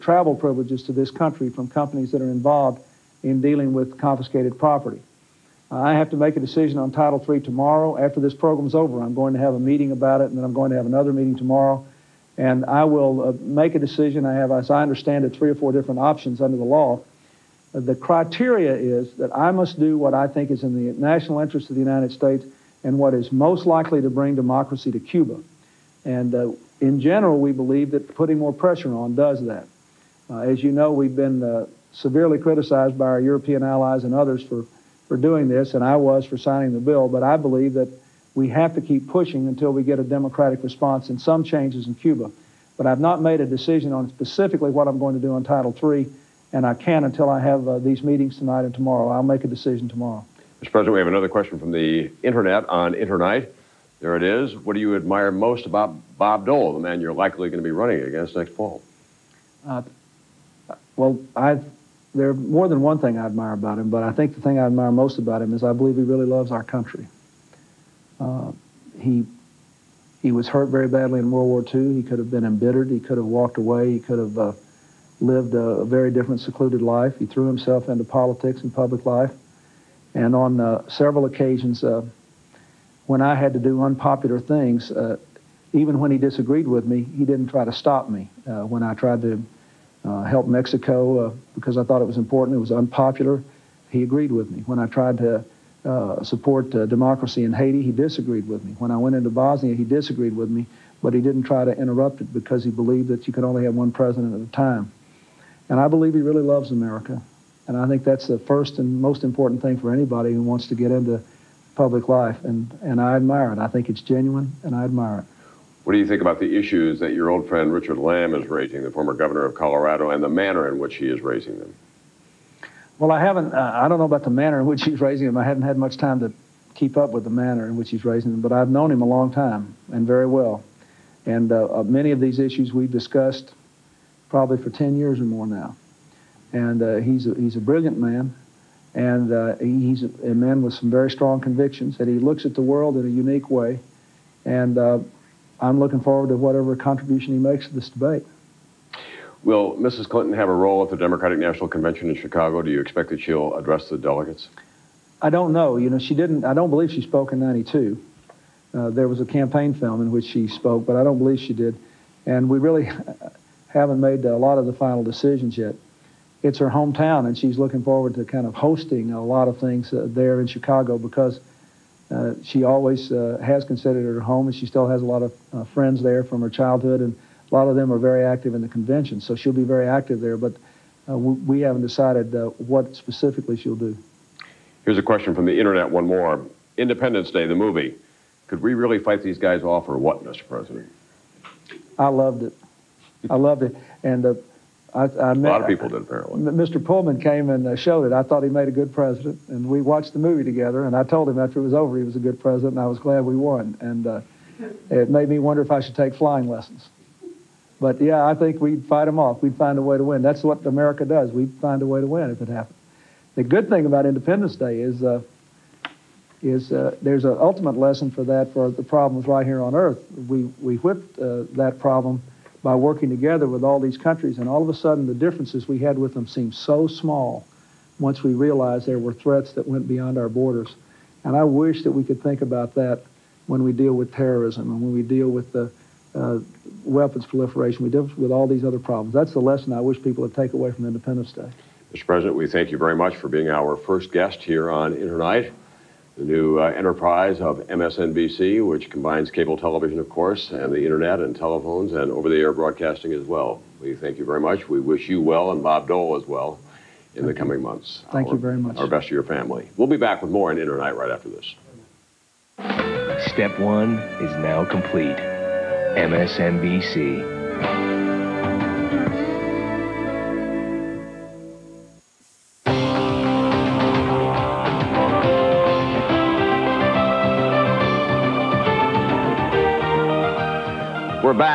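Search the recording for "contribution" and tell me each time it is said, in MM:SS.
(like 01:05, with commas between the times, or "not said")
02:26.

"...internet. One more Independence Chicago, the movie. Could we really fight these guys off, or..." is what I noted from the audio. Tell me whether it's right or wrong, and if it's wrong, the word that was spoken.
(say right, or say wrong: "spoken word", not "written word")
wrong: "Day", not "Chicago".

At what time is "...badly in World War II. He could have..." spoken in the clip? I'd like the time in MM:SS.
01:10.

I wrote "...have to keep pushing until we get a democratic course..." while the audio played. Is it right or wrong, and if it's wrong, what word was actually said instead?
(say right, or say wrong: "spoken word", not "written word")
wrong: "response", not "course".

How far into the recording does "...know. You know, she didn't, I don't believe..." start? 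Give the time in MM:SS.
02:35.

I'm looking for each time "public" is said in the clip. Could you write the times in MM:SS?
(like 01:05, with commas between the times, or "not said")
01:18, 01:51.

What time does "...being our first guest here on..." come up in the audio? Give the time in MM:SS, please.
04:03.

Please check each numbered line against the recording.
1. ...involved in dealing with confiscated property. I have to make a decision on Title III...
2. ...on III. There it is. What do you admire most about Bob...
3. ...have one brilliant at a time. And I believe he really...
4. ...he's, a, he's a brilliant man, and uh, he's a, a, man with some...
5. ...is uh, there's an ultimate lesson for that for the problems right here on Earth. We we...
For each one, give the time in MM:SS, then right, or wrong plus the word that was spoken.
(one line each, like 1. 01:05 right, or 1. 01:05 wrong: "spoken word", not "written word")
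1. 00:02 right
2. 00:52 wrong: "Internight", not "III"
3. 01:43 wrong: "president", not "brilliant"
4. 02:16 right
5. 03:36 right.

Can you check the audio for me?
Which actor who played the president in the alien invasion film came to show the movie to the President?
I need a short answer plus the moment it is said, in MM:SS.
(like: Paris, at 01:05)
Mr. Pullman, at 03:16.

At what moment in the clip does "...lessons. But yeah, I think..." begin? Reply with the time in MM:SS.
03:26.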